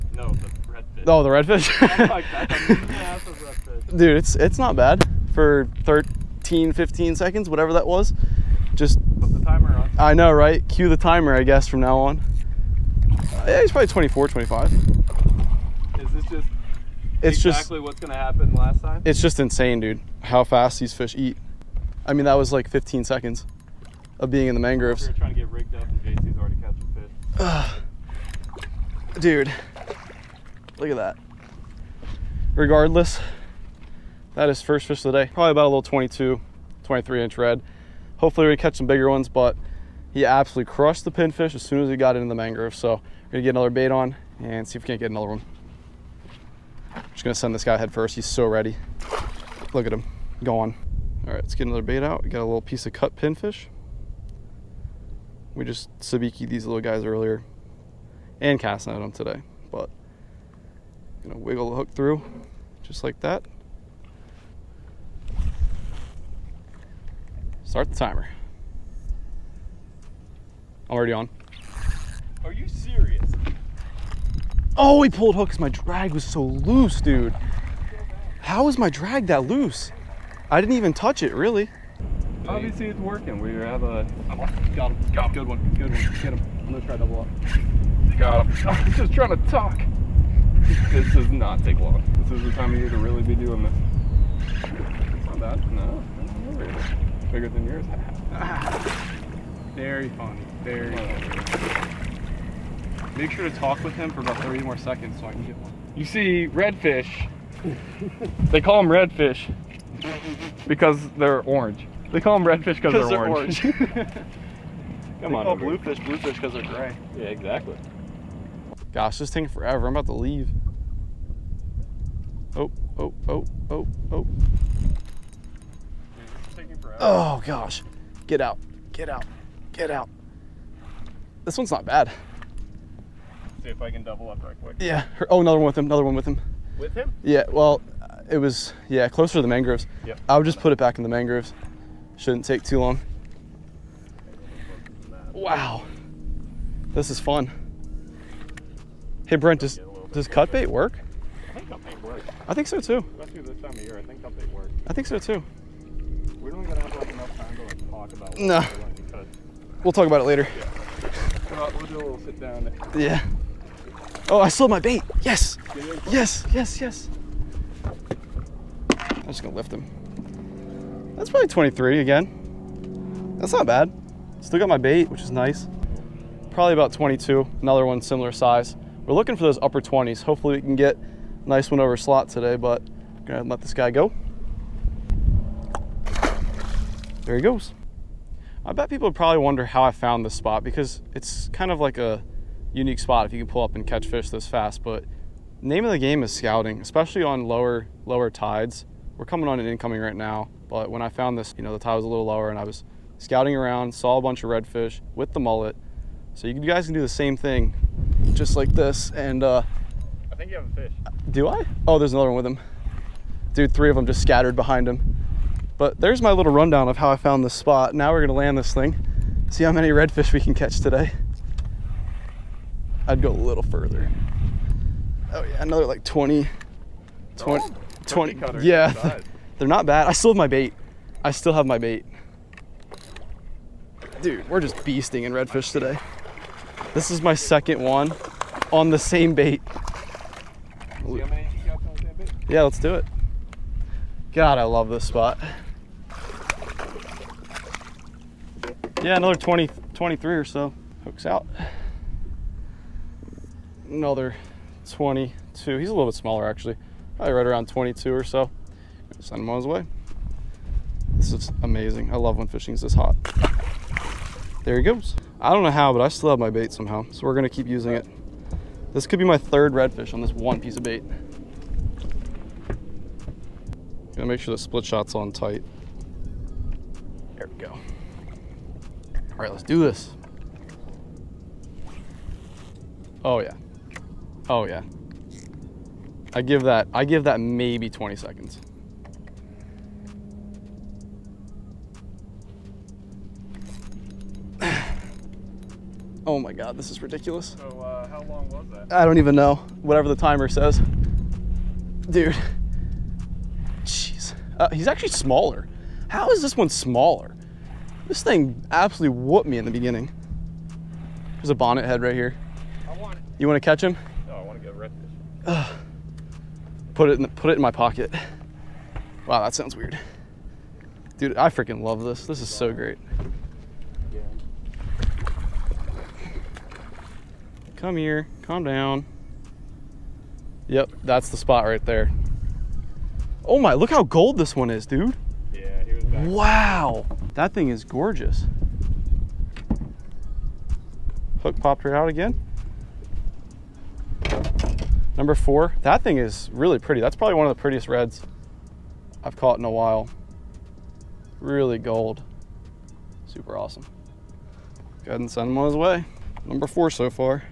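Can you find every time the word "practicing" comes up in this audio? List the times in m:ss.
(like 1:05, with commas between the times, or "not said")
not said.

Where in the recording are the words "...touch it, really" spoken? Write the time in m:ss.
1:20.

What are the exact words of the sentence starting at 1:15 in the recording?
My drag was so loose, dude.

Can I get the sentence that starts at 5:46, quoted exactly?
That's probably one of the prettiest reds I've caught in a while.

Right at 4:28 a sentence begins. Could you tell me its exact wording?
This could be my third redfish on this one piece of bait.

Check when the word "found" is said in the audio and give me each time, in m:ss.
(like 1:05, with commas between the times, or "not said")
3:09, 3:21, 3:37.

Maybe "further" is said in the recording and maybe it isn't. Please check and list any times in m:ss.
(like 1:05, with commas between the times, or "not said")
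3:43.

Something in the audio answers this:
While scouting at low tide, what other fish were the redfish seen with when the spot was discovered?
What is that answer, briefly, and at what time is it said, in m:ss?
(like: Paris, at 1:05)
mullet, at 3:25.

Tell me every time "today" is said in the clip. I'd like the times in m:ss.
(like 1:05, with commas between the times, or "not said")
0:59, 3:02, 3:40, 3:55.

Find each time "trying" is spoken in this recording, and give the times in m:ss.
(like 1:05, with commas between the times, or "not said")
0:25, 1:29.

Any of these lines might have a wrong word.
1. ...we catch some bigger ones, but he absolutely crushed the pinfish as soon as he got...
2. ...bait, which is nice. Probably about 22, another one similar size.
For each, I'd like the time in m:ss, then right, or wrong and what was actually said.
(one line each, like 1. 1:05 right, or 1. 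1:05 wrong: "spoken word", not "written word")
1. 0:38 right
2. 2:54 right.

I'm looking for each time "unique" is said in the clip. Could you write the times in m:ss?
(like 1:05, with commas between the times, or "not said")
3:12.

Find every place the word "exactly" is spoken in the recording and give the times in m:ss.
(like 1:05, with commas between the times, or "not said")
0:17, 1:57.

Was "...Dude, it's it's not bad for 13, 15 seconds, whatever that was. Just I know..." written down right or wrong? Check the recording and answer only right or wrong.
right.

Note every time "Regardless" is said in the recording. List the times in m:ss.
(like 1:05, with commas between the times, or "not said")
0:32.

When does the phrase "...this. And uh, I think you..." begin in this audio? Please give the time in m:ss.
3:28.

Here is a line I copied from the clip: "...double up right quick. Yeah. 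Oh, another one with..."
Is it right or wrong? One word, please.
right.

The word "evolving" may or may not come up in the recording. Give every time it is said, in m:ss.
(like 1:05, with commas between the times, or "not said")
not said.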